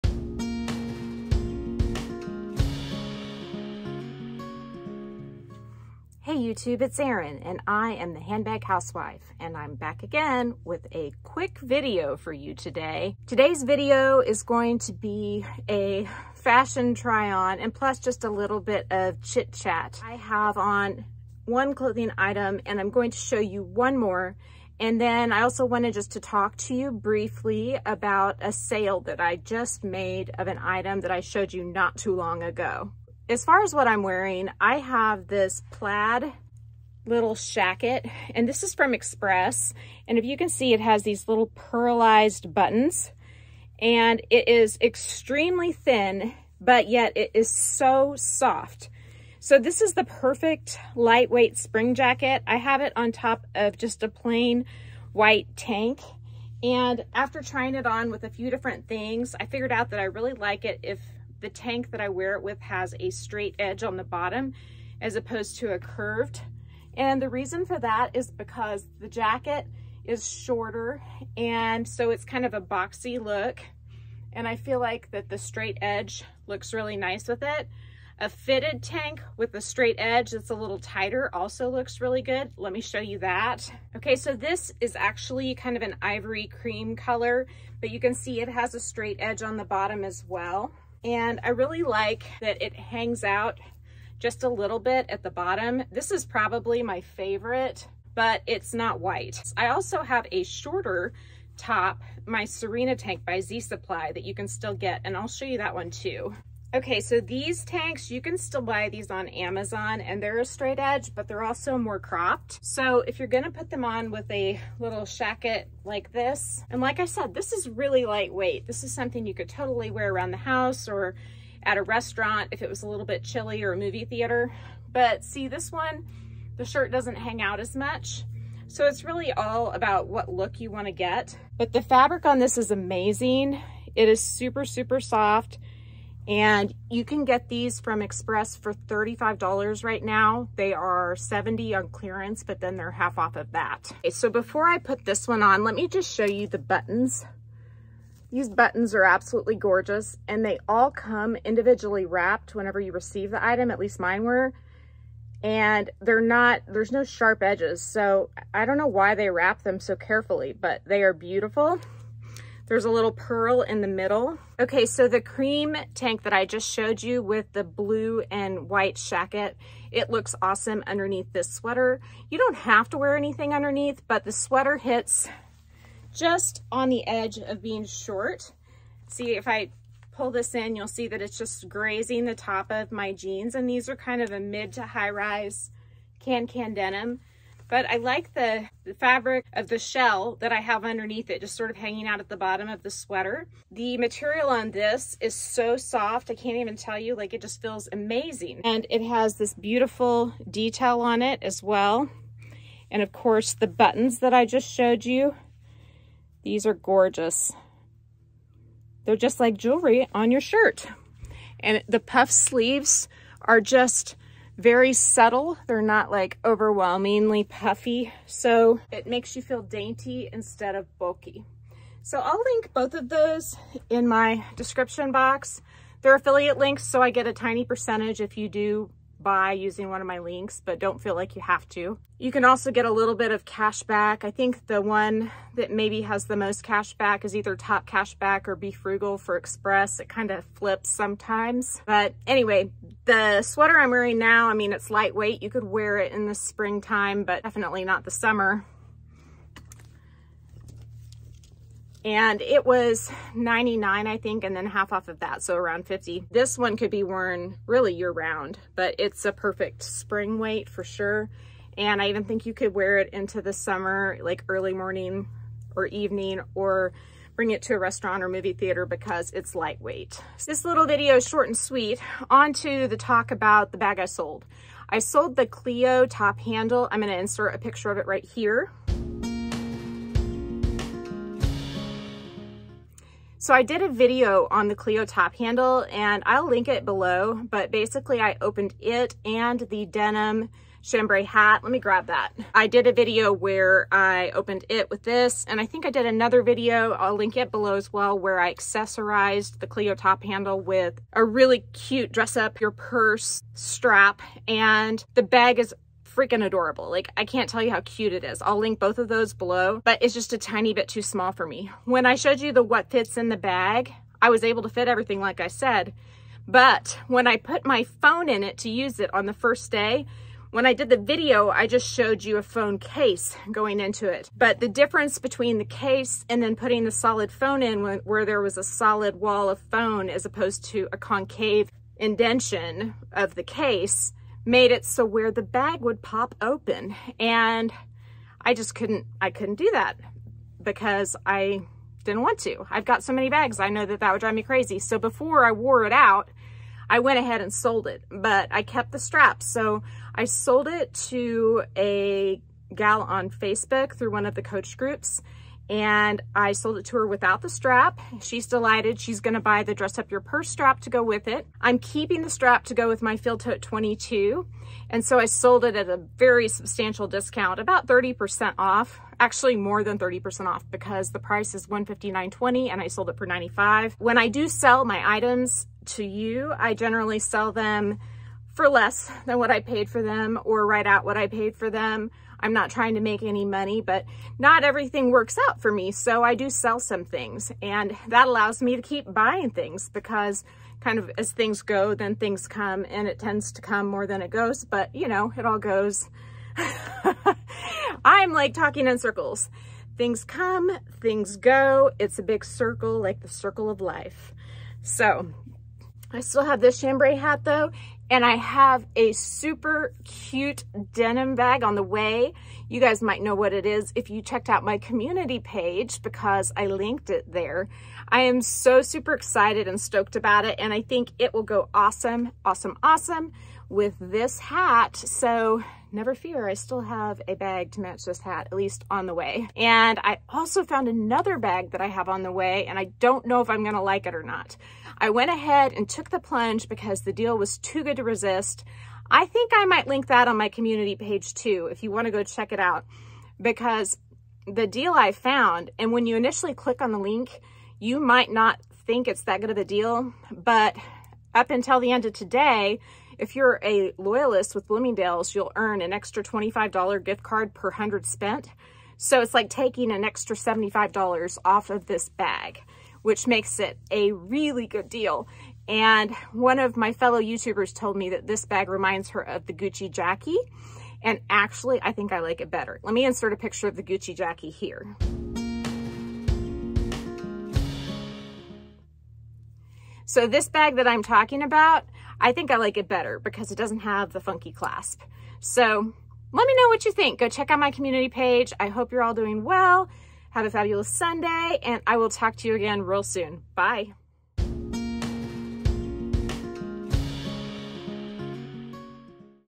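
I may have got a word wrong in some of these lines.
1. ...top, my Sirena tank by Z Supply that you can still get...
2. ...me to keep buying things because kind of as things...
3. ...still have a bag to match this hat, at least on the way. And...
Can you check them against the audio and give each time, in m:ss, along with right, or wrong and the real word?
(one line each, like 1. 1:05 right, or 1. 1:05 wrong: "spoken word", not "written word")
1. 1:41 right
2. 6:28 right
3. 7:06 right.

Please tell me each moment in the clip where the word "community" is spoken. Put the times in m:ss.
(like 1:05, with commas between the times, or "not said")
6:54, 7:20, 8:07.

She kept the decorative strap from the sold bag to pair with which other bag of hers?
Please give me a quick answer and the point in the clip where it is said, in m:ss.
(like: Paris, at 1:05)
Field Tote 22, at 6:03.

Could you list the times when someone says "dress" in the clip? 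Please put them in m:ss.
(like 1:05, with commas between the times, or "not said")
5:02, 5:59.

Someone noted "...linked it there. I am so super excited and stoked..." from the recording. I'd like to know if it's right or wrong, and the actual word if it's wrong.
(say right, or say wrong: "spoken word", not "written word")
right.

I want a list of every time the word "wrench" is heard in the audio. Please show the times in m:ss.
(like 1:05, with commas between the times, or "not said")
not said.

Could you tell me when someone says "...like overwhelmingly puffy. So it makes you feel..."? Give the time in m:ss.
3:36.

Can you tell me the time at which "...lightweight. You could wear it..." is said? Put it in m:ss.
4:04.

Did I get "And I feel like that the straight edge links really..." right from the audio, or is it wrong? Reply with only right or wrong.
wrong.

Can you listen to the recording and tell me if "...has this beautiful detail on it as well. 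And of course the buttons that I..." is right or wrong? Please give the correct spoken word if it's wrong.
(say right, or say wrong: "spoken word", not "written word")
right.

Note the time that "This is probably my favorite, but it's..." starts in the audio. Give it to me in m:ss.
1:35.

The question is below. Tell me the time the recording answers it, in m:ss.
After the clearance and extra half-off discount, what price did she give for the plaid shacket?
2:18.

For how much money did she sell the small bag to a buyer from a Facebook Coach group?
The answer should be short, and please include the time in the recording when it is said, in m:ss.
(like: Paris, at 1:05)
$95, at 6:13.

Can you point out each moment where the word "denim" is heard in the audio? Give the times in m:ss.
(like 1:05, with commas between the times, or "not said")
3:06, 4:49, 6:50.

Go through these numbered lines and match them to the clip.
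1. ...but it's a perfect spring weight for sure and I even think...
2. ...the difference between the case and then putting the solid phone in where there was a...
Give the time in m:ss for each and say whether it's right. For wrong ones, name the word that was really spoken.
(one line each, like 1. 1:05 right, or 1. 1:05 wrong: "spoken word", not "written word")
1. 4:18 right
2. 5:24 right.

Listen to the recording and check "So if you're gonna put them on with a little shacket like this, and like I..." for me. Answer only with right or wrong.
right.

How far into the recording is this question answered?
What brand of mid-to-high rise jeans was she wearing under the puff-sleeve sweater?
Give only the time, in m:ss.
3:06.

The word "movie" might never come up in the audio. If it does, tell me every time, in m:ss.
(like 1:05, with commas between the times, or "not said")
2:03, 4:28.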